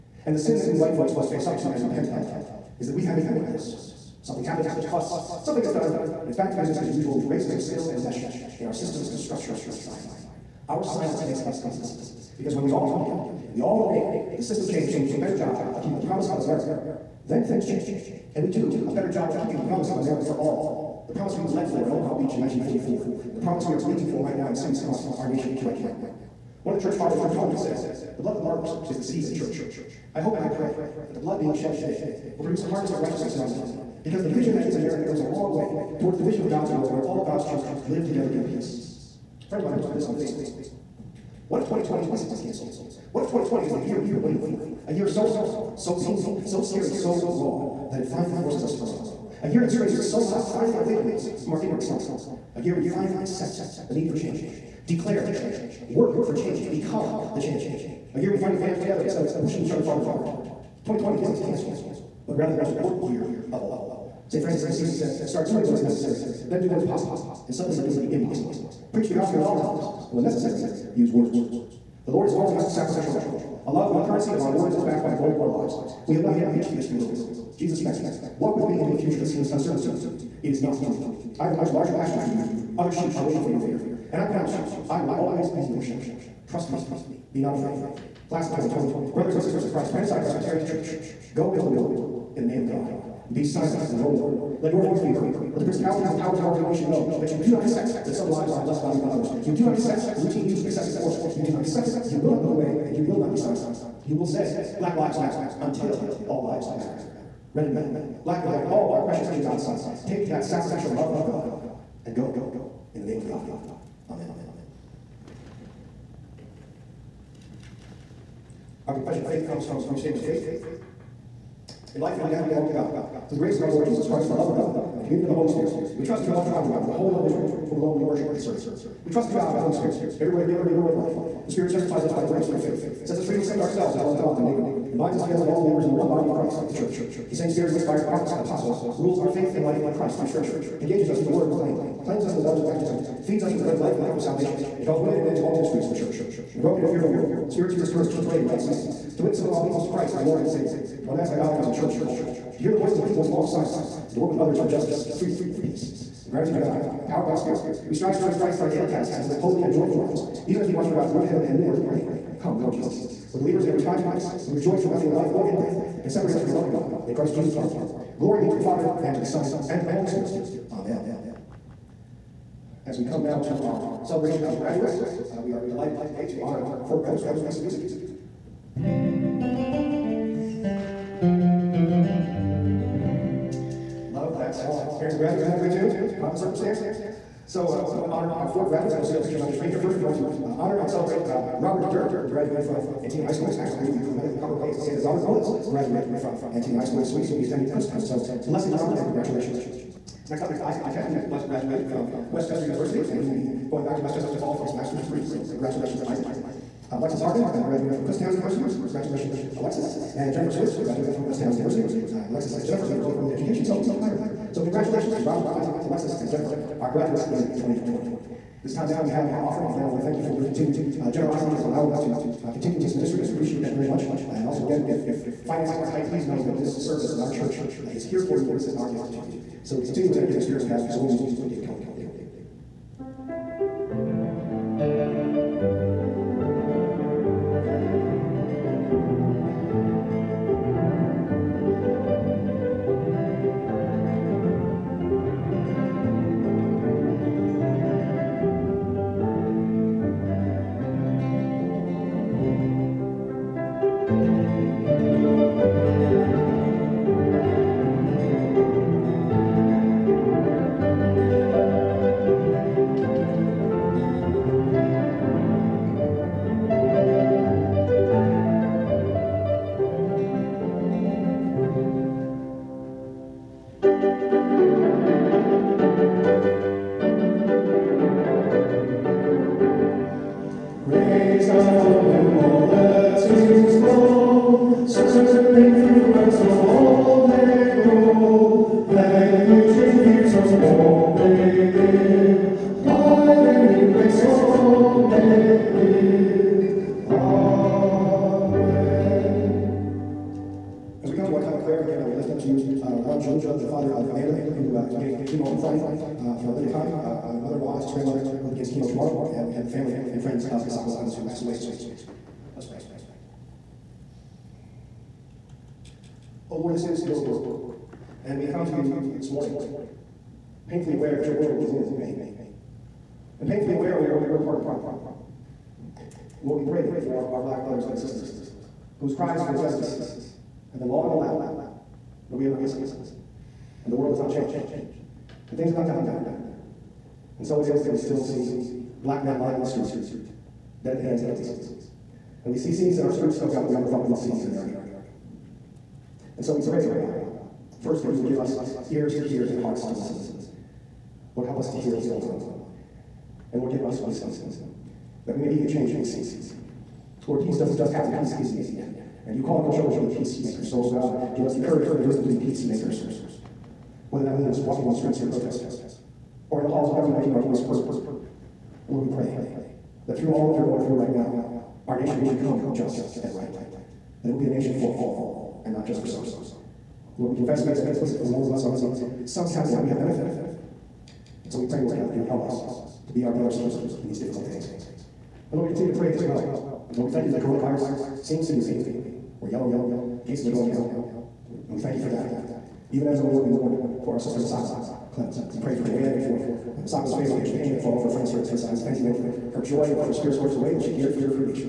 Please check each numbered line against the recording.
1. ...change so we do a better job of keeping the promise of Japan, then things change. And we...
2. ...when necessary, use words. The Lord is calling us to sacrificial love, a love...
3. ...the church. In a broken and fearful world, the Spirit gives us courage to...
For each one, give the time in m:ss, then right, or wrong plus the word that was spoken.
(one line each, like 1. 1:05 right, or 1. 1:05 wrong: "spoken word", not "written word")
1. 0:14 wrong: "America", not "Japan"
2. 1:10 right
3. 2:25 right.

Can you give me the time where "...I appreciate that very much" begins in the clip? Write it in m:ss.
3:43.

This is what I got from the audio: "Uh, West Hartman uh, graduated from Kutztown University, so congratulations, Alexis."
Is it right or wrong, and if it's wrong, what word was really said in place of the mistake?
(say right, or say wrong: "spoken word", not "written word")
wrong: "Alexis", not "West".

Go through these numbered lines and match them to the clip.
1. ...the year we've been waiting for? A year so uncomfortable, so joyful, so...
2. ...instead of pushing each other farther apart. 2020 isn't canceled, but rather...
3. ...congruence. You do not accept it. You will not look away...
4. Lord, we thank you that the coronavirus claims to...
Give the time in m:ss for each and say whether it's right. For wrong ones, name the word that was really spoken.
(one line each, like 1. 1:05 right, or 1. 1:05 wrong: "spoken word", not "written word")
1. 0:43 wrong: "painful", not "joyful"
2. 0:59 right
3. 1:40 wrong: "force", not "congruence"
4. 6:26 wrong: "seems", not "claims".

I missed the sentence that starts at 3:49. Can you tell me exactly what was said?
So to continue with that giving spirit, we have some more music from David Cullen.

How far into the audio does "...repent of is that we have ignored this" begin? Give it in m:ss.
0:01.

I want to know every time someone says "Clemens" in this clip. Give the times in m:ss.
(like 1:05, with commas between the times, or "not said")
5:10, 6:35.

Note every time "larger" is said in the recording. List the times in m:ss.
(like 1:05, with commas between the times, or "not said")
1:21.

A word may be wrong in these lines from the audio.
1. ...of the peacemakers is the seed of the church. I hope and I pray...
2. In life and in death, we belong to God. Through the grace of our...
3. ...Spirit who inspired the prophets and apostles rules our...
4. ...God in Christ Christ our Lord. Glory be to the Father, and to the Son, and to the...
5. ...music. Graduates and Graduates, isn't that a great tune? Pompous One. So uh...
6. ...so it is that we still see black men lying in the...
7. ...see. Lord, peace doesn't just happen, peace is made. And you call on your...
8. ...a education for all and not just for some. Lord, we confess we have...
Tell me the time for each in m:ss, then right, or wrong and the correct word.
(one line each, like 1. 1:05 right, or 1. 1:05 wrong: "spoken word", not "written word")
1. 0:28 wrong: "martyrs", not "peacemakers"
2. 2:01 right
3. 2:17 right
4. 2:46 wrong: "Jesus", not "Christ"
5. 2:57 wrong: "Circumstance", not "One"
6. 5:37 right
7. 5:56 right
8. 6:14 wrong: "nation", not "education".